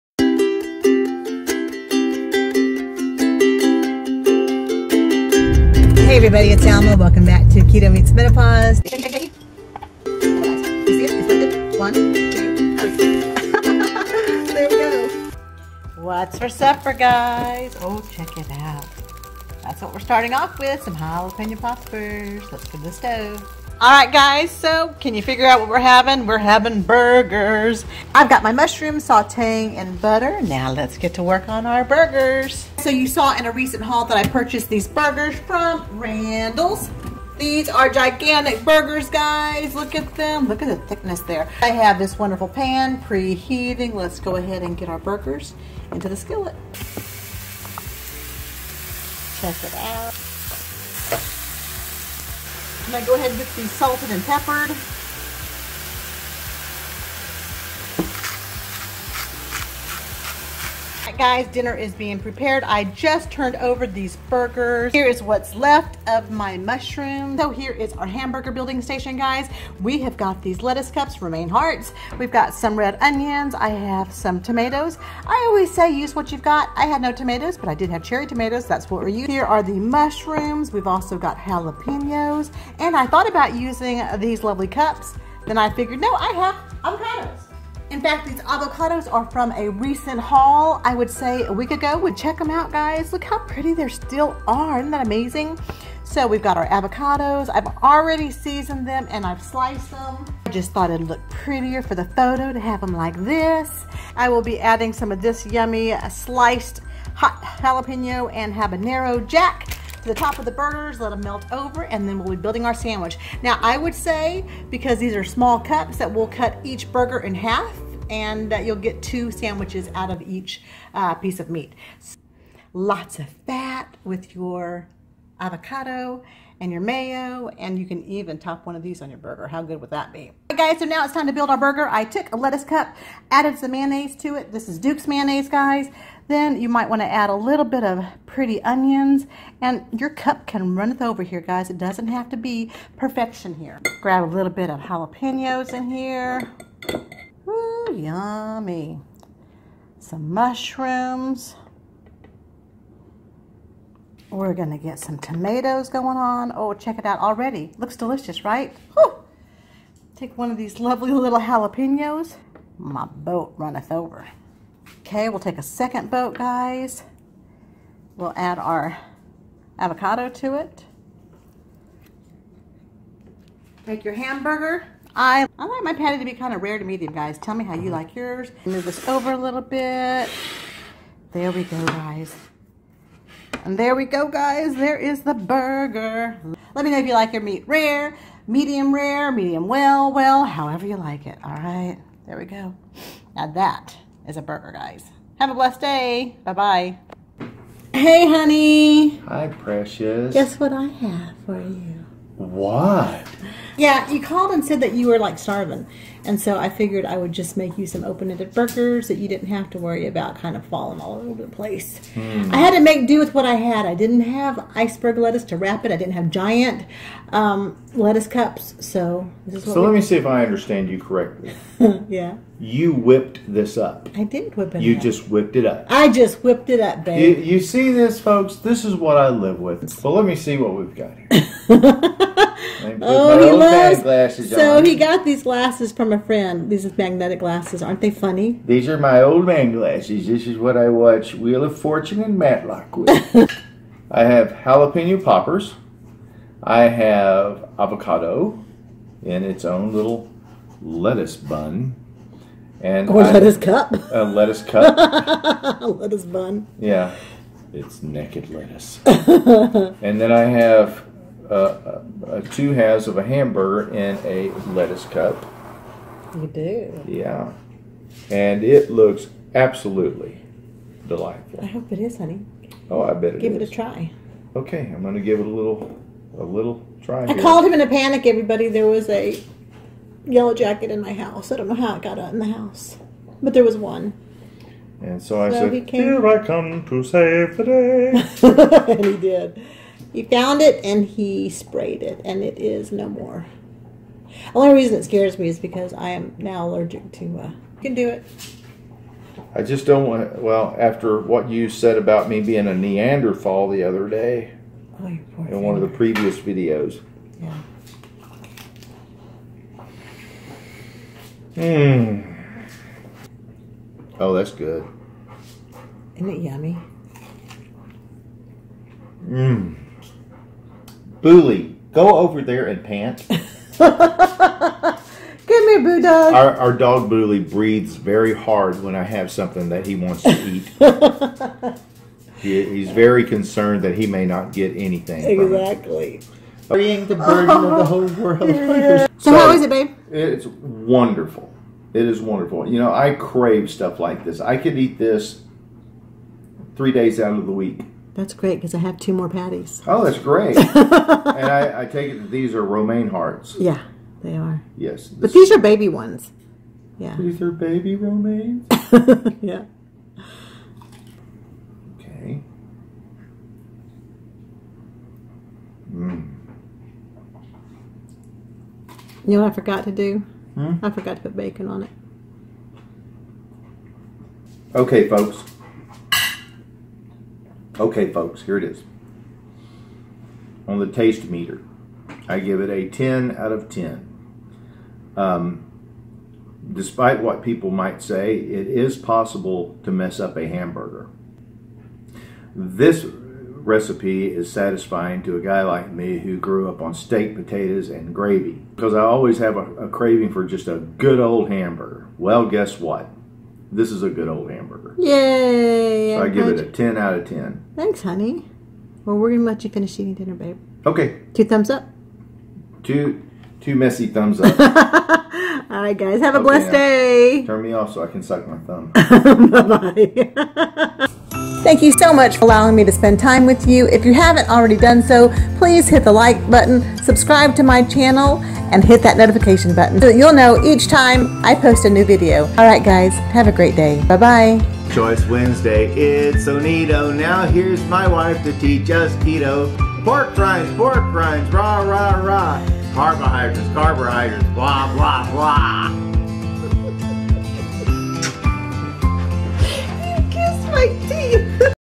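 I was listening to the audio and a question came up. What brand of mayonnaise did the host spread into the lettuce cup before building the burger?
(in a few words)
Duke's.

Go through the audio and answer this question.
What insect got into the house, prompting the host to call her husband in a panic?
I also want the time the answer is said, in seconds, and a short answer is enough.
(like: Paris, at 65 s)
yellow jacket, at 280 s.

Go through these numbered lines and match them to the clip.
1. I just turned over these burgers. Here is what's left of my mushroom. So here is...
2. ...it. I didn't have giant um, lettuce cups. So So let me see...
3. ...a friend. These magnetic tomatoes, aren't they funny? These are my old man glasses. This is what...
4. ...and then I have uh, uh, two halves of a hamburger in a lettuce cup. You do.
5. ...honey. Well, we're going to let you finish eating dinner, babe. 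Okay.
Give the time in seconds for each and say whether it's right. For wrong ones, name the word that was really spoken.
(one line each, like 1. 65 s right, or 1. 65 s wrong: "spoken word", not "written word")
1. 62 s right
2. 215 s right
3. 236 s wrong: "glasses", not "tomatoes"
4. 259 s right
5. 408 s right.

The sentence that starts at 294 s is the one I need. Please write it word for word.
The only reason it scares me is because I am now allergic to.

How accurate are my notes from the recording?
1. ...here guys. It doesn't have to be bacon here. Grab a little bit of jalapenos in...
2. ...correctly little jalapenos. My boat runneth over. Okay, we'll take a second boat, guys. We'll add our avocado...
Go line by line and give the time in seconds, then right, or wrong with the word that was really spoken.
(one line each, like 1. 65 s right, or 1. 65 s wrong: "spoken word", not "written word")
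1. 141 s wrong: "perfection", not "bacon"
2. 160 s wrong: "lovely", not "correctly".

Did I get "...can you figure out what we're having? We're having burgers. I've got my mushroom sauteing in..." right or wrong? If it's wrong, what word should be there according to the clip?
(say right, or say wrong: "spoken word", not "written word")
right.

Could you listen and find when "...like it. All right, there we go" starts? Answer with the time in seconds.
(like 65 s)
190 s.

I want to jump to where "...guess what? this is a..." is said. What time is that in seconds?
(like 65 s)
402 s.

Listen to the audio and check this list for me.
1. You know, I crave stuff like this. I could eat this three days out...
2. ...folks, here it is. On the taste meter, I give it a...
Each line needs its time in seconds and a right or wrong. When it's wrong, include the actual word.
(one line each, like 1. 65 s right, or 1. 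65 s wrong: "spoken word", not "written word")
1. 342 s right
2. 378 s right.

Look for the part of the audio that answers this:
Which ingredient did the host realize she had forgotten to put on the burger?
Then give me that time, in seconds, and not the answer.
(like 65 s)
371 s.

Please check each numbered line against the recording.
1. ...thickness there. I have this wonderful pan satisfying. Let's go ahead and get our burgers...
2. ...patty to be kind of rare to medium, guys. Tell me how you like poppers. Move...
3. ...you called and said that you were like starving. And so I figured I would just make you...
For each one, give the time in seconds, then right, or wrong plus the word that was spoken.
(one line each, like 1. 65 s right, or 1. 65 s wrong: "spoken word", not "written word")
1. 40 s wrong: "preheating", not "satisfying"
2. 175 s wrong: "yours", not "poppers"
3. 204 s right.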